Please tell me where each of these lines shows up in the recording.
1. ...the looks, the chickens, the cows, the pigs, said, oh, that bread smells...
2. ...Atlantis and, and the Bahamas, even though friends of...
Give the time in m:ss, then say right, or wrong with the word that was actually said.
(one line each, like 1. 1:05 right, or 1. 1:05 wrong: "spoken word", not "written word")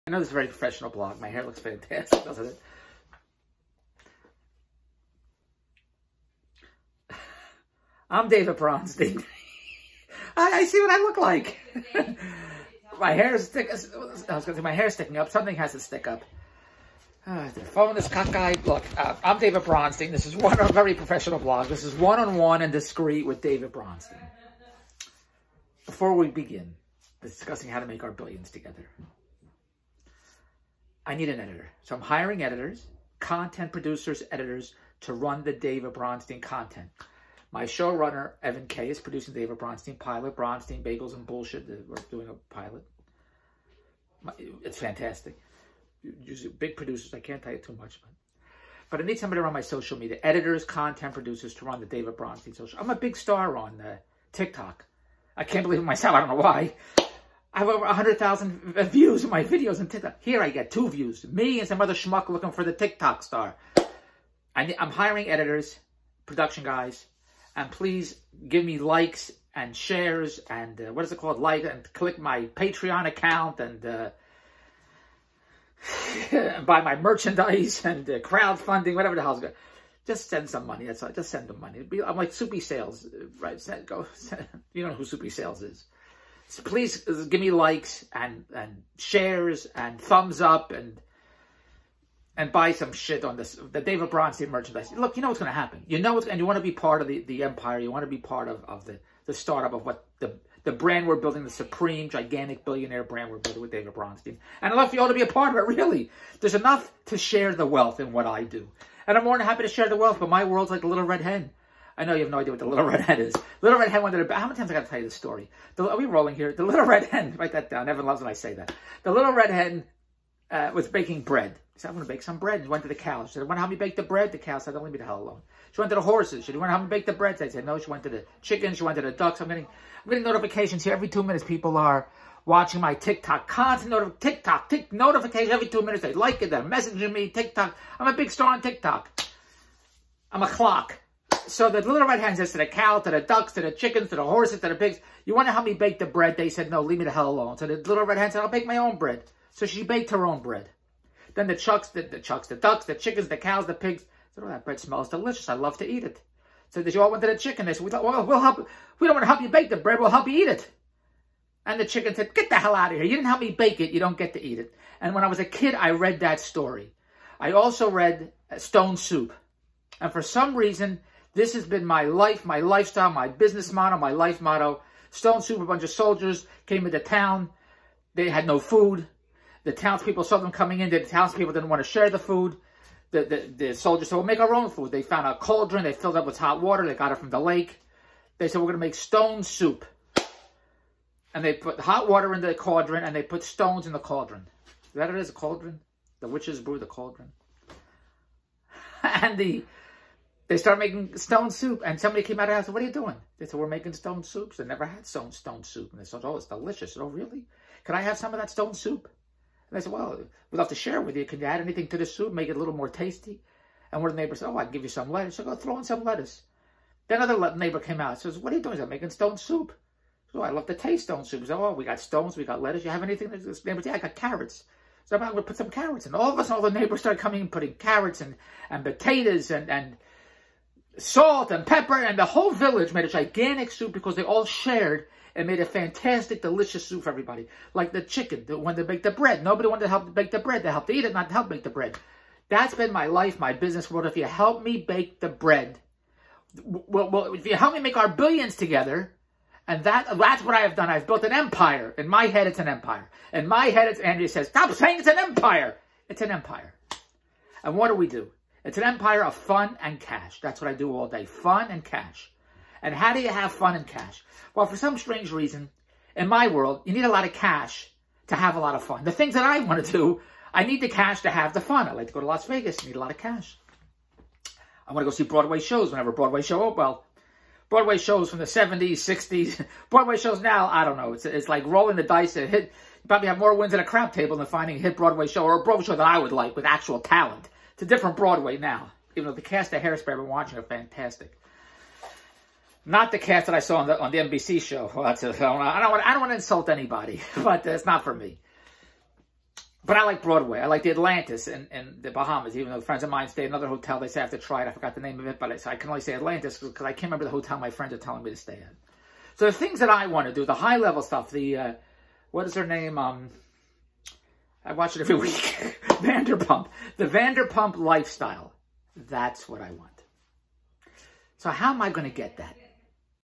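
1. 2:32 wrong: "ducks", not "looks"
2. 5:00 right.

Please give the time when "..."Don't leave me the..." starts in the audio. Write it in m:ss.
2:04.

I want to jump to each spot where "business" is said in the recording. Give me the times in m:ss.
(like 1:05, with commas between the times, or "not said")
2:53, 4:03.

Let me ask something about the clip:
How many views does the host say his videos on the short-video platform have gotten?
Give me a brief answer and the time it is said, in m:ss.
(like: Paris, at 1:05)
over 100,000, at 0:57.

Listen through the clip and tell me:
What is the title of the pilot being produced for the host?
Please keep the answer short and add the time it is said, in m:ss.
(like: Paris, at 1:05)
Bronstein Bagels and Bullshit, at 0:40.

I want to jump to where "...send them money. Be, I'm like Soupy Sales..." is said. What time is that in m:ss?
1:21.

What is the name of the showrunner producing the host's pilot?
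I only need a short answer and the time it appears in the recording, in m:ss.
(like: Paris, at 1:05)
Evan Kay, at 0:38.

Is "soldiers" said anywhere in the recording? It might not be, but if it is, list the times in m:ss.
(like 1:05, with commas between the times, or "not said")
2:55, 3:03.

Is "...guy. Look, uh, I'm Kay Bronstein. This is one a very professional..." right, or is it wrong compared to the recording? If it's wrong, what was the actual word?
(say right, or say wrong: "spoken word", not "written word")
wrong: "David", not "Kay".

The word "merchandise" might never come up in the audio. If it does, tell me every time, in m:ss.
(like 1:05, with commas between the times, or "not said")
1:16, 1:34.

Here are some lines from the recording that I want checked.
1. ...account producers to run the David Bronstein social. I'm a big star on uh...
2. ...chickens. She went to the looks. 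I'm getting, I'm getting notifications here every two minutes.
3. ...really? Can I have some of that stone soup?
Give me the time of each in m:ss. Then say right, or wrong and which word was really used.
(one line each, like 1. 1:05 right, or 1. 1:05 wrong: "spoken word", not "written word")
1. 0:50 wrong: "content", not "account"
2. 2:08 wrong: "ducks", not "looks"
3. 3:27 right.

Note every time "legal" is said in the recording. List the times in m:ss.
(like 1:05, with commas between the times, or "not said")
not said.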